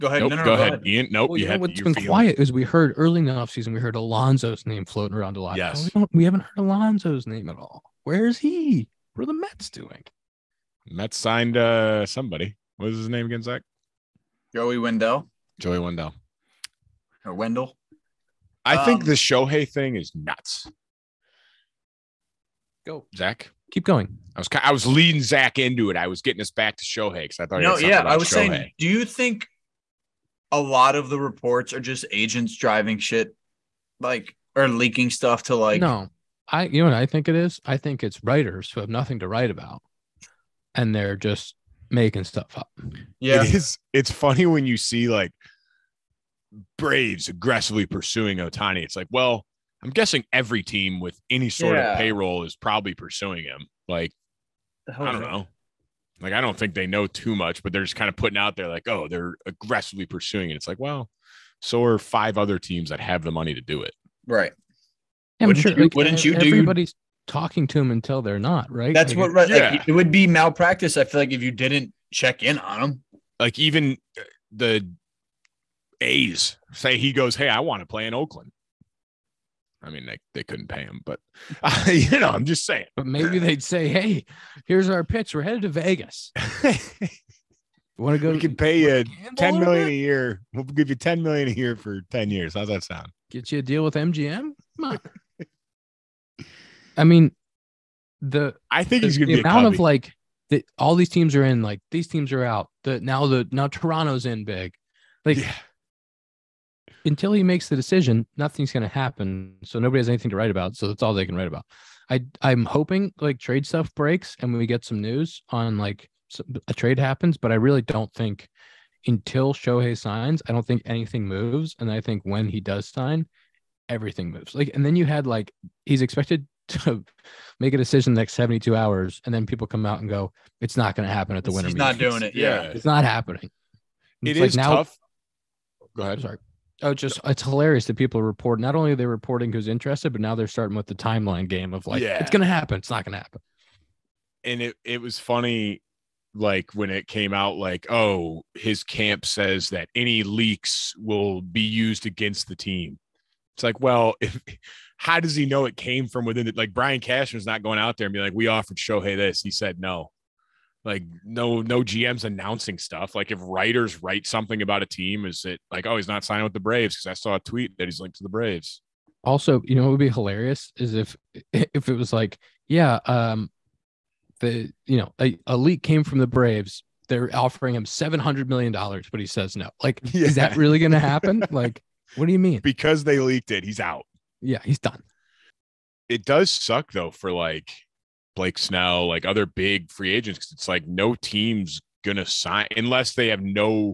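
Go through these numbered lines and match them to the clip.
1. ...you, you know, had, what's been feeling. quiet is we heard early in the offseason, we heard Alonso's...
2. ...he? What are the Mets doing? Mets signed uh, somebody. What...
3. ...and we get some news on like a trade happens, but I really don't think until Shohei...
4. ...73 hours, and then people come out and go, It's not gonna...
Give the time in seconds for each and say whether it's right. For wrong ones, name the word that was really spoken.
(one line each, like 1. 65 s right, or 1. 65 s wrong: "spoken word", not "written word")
1. 1 s right
2. 8 s right
3. 114 s right
4. 128 s wrong: "72", not "73".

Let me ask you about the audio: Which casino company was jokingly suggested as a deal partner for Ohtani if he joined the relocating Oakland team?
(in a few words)
MGM.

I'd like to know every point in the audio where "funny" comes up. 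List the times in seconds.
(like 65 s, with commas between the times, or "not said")
44 s, 145 s.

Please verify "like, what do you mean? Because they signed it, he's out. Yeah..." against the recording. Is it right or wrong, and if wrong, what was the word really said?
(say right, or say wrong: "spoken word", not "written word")
wrong: "leaked", not "signed".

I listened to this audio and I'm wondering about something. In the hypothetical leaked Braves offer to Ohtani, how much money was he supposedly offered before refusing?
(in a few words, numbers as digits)
$700 million.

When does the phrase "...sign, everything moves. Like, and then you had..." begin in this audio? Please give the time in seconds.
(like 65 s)
122 s.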